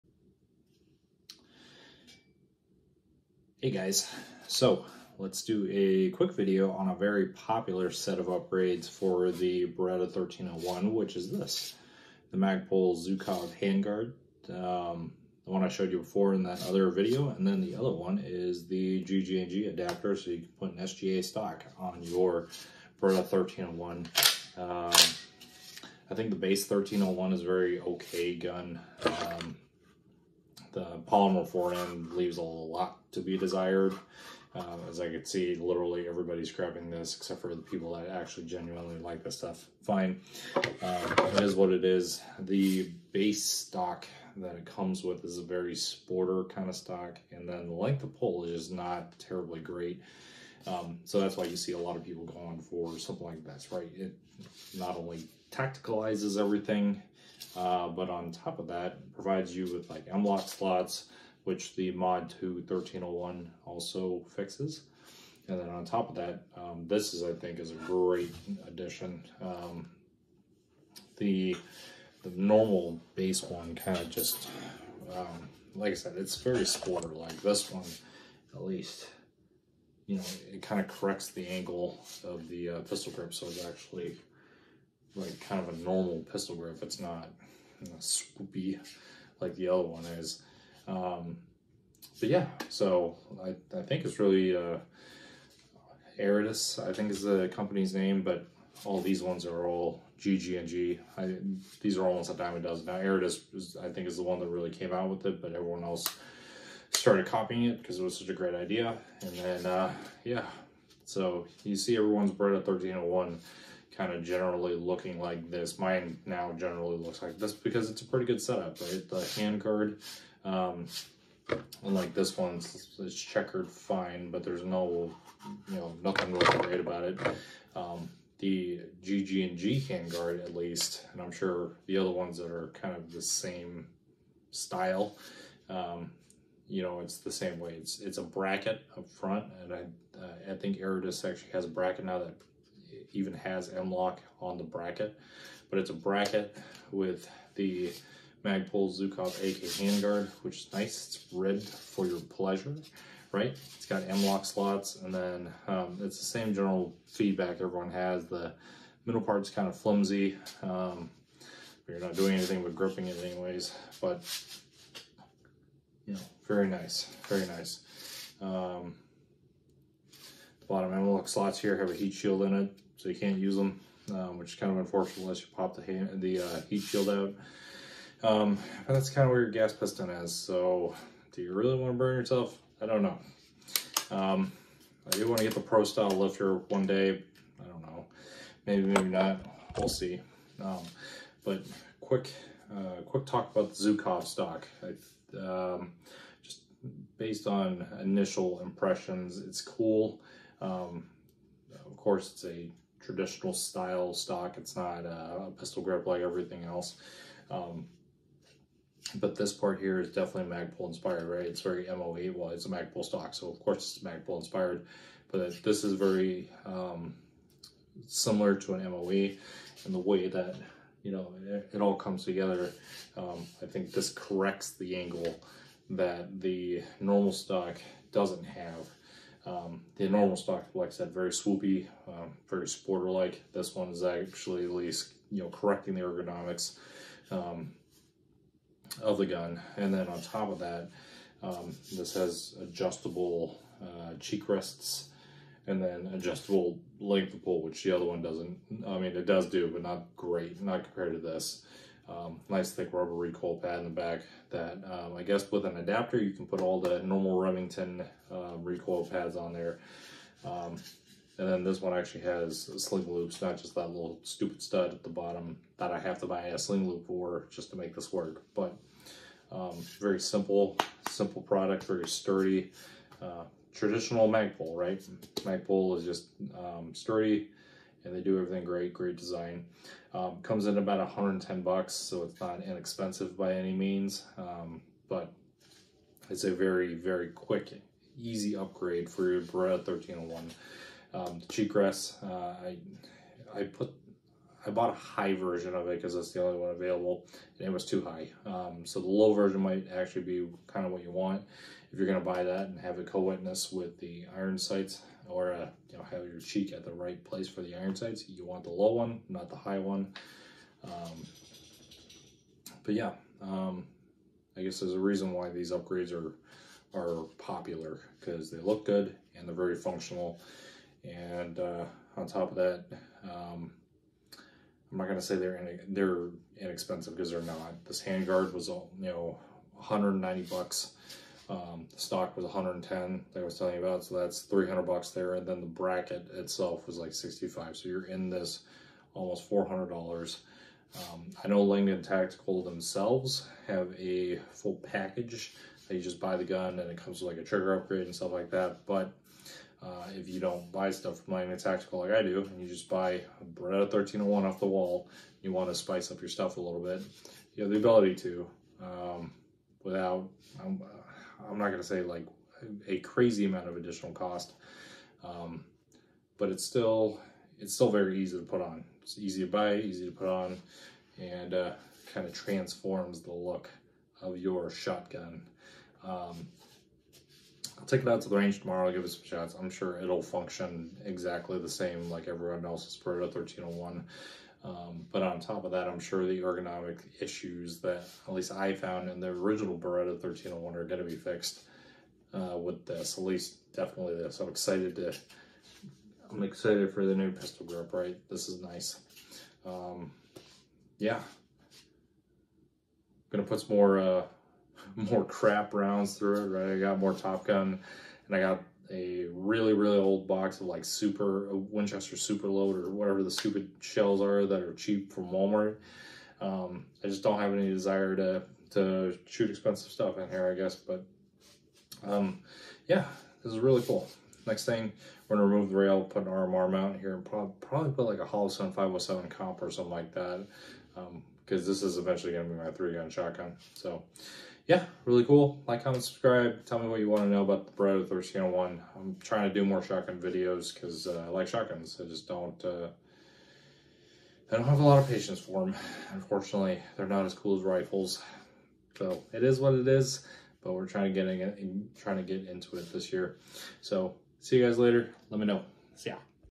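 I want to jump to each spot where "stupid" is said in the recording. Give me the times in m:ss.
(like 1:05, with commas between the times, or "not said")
4:24, 6:53.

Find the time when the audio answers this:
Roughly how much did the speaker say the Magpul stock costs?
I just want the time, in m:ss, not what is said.
4:40.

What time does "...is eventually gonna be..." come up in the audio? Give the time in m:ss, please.
7:11.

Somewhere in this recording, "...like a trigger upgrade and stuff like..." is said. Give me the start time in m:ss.
5:47.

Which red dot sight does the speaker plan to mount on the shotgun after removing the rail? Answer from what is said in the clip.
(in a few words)
Holosun 507 comp.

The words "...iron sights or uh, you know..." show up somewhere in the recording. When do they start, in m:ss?
5:04.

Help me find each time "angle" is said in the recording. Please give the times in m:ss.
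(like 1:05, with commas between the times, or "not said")
1:21, 3:44.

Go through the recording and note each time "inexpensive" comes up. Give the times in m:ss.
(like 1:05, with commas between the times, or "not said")
4:42, 5:26.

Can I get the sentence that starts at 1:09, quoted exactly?
Um, the, the normal base one kind of just, um, like I said, it's very sporter.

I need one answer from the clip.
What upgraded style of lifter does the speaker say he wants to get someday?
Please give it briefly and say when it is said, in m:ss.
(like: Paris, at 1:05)
Pro Style lifter, at 3:05.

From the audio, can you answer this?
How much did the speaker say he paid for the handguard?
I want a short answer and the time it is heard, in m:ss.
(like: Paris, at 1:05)
$190, at 5:29.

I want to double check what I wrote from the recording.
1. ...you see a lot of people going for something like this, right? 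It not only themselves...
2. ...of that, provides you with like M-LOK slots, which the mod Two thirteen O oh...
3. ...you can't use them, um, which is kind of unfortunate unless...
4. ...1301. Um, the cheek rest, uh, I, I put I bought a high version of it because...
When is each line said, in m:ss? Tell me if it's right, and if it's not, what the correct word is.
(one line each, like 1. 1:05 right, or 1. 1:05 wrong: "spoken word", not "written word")
1. 0:51 wrong: "tacticalizes", not "themselves"
2. 0:58 right
3. 2:53 right
4. 4:49 right.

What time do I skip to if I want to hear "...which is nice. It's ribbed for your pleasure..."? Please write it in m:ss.
2:30.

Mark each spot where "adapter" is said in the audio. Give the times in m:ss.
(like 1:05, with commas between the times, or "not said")
0:19, 4:15.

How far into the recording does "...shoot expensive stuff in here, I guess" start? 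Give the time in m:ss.
6:59.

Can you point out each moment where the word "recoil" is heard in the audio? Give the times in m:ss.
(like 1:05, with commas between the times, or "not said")
4:13, 4:18.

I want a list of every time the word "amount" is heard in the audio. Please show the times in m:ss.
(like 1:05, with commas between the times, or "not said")
6:03.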